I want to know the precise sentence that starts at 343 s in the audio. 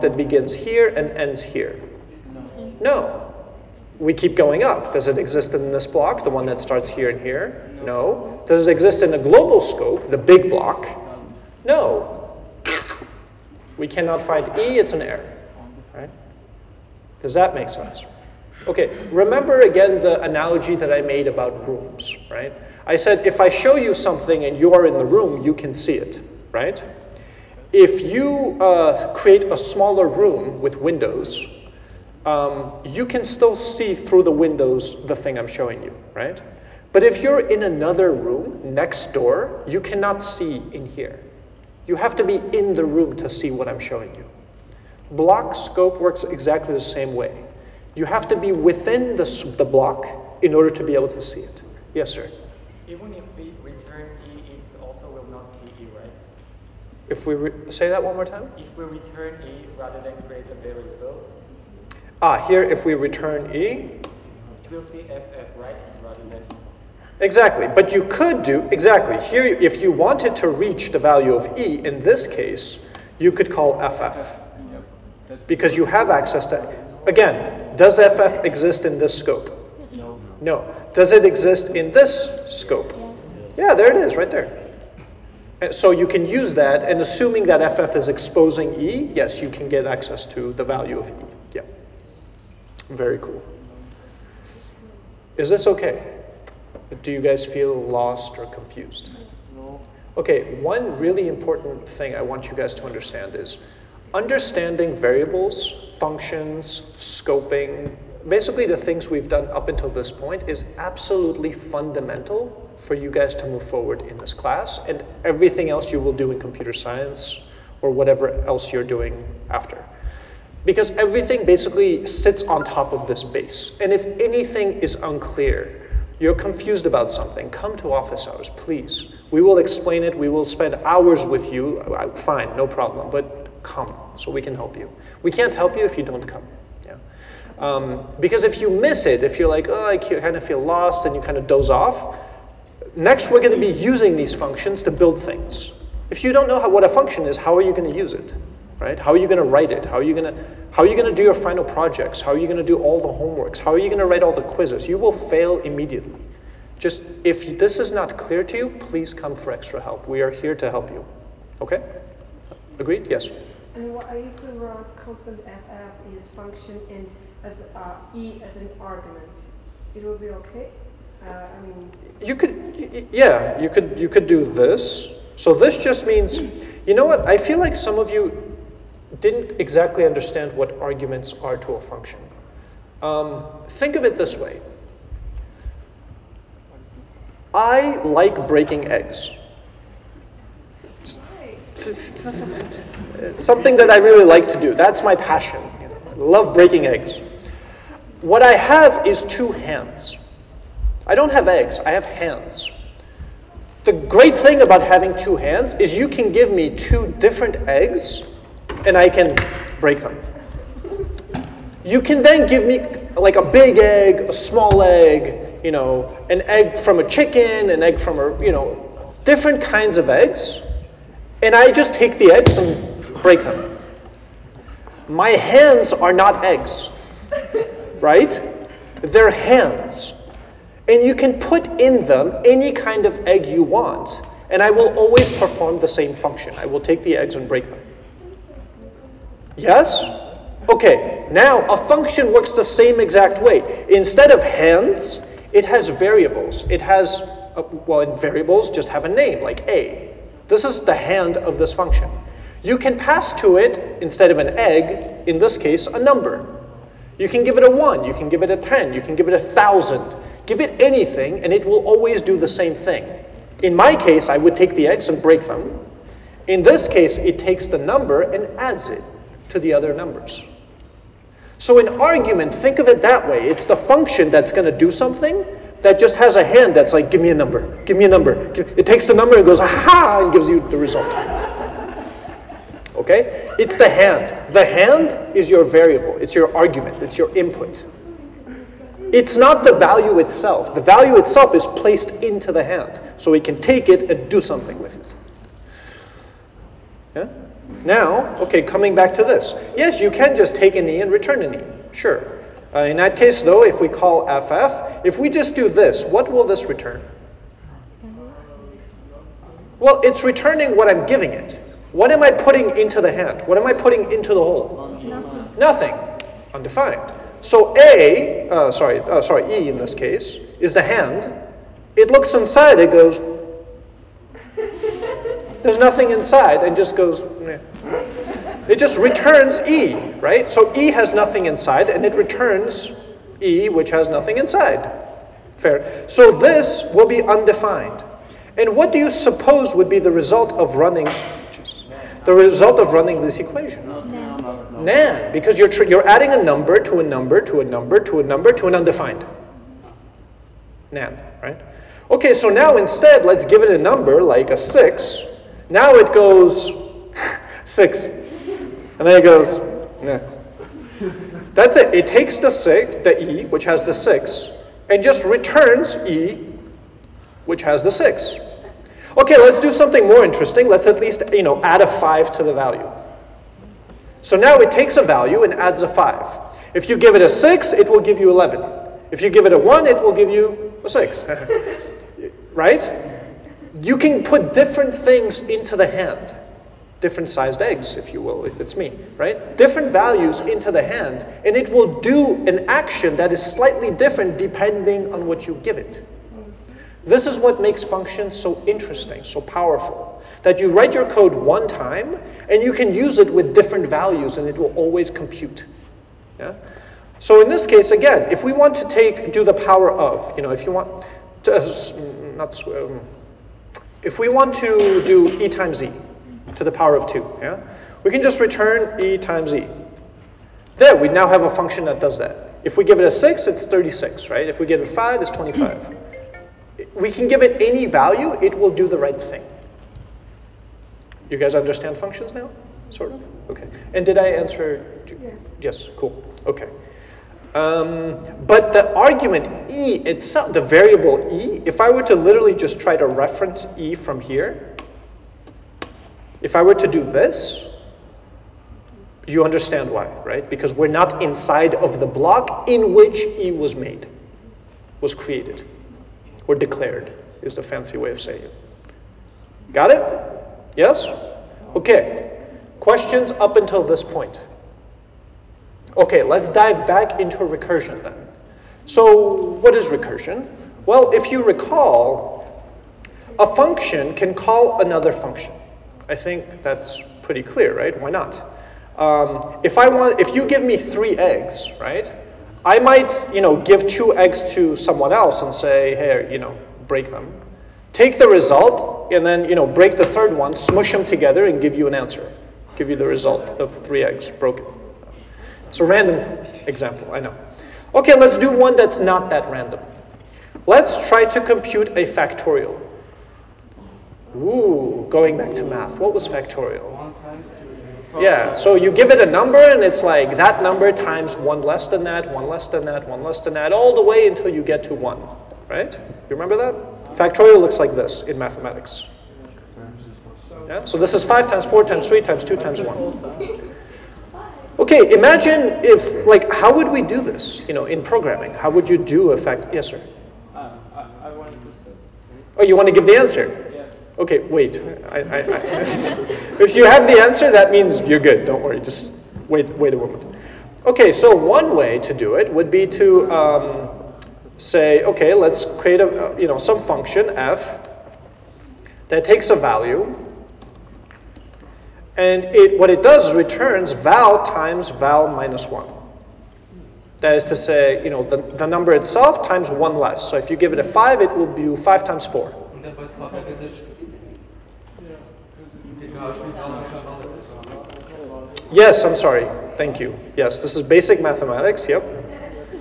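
NaN, NaN because you're, you're adding a number to a number to a number to a number to an undefined.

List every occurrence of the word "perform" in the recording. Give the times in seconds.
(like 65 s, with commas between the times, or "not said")
235 s.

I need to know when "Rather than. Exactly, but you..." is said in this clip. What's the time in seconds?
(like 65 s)
66 s.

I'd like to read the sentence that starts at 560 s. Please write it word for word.
So if you give it a five, it will be five times four.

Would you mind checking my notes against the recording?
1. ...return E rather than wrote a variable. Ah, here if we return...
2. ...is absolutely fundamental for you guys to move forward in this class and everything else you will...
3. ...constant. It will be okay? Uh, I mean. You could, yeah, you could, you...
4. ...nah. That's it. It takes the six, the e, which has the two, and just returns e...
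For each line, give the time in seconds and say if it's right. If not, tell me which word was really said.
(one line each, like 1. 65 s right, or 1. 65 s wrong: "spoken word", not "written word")
1. 58 s wrong: "create", not "wrote"
2. 110 s right
3. 168 s wrong: "argument", not "constant"
4. 360 s wrong: "six", not "two".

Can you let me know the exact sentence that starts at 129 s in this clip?
We will explain it, we will spend hours with you, fine, no problem, but come so we can help you.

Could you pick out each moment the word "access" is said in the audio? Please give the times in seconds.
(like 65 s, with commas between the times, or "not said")
76 s, 89 s.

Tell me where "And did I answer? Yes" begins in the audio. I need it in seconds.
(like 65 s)
433 s.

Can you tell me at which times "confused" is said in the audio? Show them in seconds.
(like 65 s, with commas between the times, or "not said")
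98 s, 126 s.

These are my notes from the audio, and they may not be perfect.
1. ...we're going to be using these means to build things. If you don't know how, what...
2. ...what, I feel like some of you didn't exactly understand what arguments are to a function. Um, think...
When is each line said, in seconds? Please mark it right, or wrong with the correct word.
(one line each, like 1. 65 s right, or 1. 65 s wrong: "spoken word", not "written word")
1. 143 s wrong: "functions", not "means"
2. 177 s right.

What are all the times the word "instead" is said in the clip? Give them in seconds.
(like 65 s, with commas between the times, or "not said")
243 s, 254 s, 352 s.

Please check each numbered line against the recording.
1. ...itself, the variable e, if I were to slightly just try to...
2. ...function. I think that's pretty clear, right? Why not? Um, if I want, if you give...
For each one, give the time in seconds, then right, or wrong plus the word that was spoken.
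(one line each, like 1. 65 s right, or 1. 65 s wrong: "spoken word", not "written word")
1. 440 s wrong: "literally", not "slightly"
2. 475 s right.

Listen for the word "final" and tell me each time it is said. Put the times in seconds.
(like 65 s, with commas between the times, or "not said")
151 s.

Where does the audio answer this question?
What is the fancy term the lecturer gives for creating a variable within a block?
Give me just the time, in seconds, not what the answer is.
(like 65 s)
456 s.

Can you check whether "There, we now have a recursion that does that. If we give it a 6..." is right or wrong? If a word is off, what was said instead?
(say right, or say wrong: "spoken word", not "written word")
wrong: "function", not "recursion".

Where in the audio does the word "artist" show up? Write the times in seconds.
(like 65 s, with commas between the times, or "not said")
not said.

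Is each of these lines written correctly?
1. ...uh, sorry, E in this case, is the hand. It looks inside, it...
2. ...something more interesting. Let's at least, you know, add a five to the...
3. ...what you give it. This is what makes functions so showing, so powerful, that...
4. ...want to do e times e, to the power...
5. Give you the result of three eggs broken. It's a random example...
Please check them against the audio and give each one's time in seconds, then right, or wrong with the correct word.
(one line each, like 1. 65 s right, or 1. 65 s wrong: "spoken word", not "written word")
1. 319 s right
2. 369 s right
3. 395 s wrong: "interesting", not "showing"
4. 414 s right
5. 492 s right.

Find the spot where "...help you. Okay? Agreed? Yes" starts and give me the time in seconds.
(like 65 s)
160 s.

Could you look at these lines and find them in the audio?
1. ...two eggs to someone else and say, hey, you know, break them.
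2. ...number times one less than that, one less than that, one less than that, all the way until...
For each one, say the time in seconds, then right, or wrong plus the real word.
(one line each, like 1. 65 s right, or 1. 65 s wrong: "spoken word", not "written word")
1. 483 s right
2. 510 s right.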